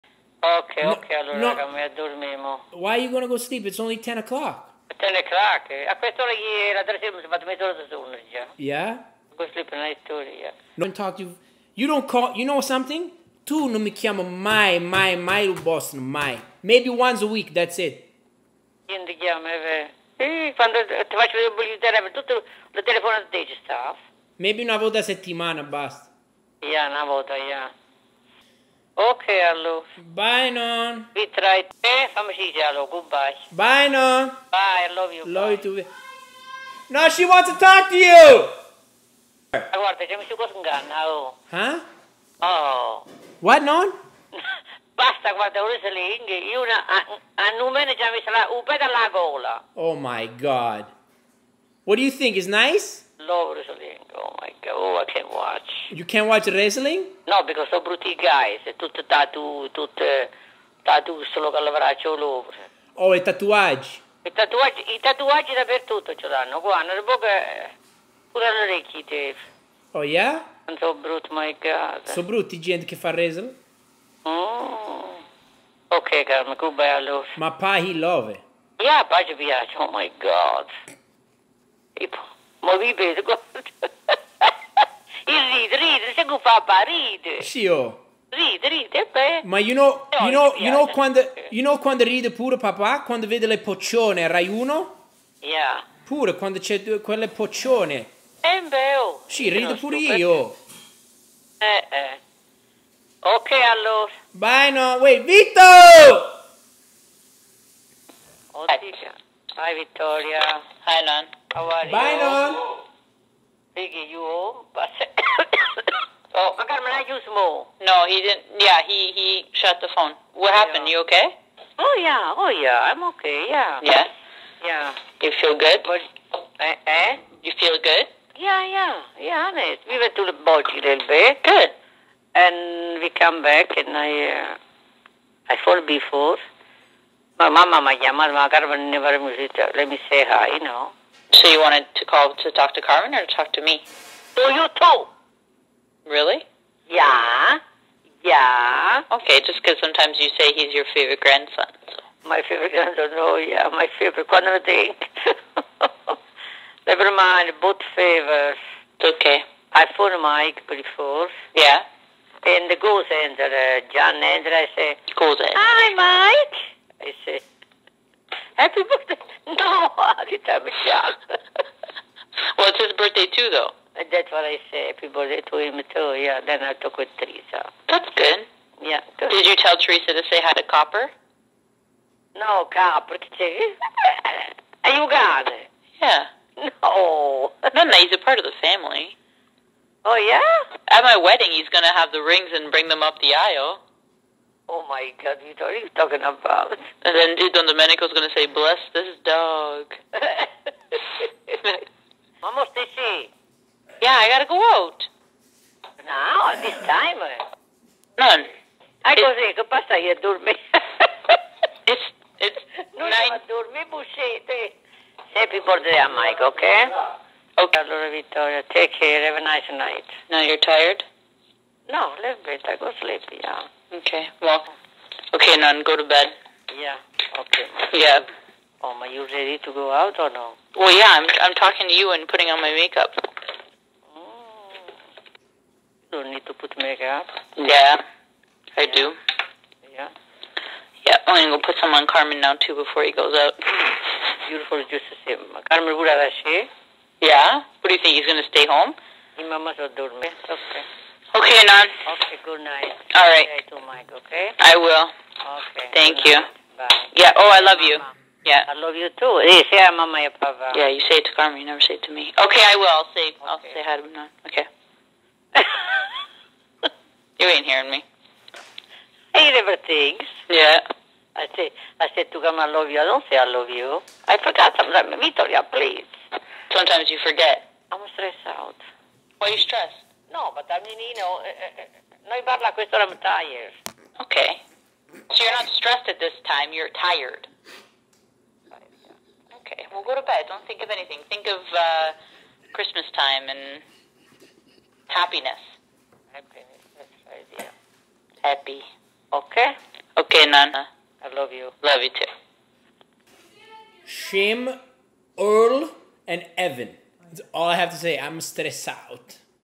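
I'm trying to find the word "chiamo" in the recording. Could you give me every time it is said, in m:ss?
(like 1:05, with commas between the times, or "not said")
0:13, 0:19.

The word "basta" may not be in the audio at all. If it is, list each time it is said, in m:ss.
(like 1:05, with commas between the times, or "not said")
0:25, 0:44.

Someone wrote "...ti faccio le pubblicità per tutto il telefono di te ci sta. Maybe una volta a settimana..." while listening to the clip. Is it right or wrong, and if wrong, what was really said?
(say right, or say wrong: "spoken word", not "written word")
right.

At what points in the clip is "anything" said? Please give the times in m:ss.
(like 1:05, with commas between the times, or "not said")
4:50.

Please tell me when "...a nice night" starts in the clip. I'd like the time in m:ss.
3:39.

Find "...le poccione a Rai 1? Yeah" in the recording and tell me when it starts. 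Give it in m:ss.
1:33.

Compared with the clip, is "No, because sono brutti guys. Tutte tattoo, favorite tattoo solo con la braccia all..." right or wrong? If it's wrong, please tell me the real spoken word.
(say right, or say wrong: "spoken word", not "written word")
wrong: "tutte", not "favorite".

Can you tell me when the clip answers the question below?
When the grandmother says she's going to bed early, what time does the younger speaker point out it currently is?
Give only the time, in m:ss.
0:03.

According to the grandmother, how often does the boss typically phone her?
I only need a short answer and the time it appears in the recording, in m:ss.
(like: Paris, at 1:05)
once a week, at 0:16.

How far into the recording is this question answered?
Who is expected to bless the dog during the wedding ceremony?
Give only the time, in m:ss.
3:17.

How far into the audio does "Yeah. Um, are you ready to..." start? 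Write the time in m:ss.
3:47.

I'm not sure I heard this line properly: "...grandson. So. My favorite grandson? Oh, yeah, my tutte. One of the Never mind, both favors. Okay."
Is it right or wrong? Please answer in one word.
wrong.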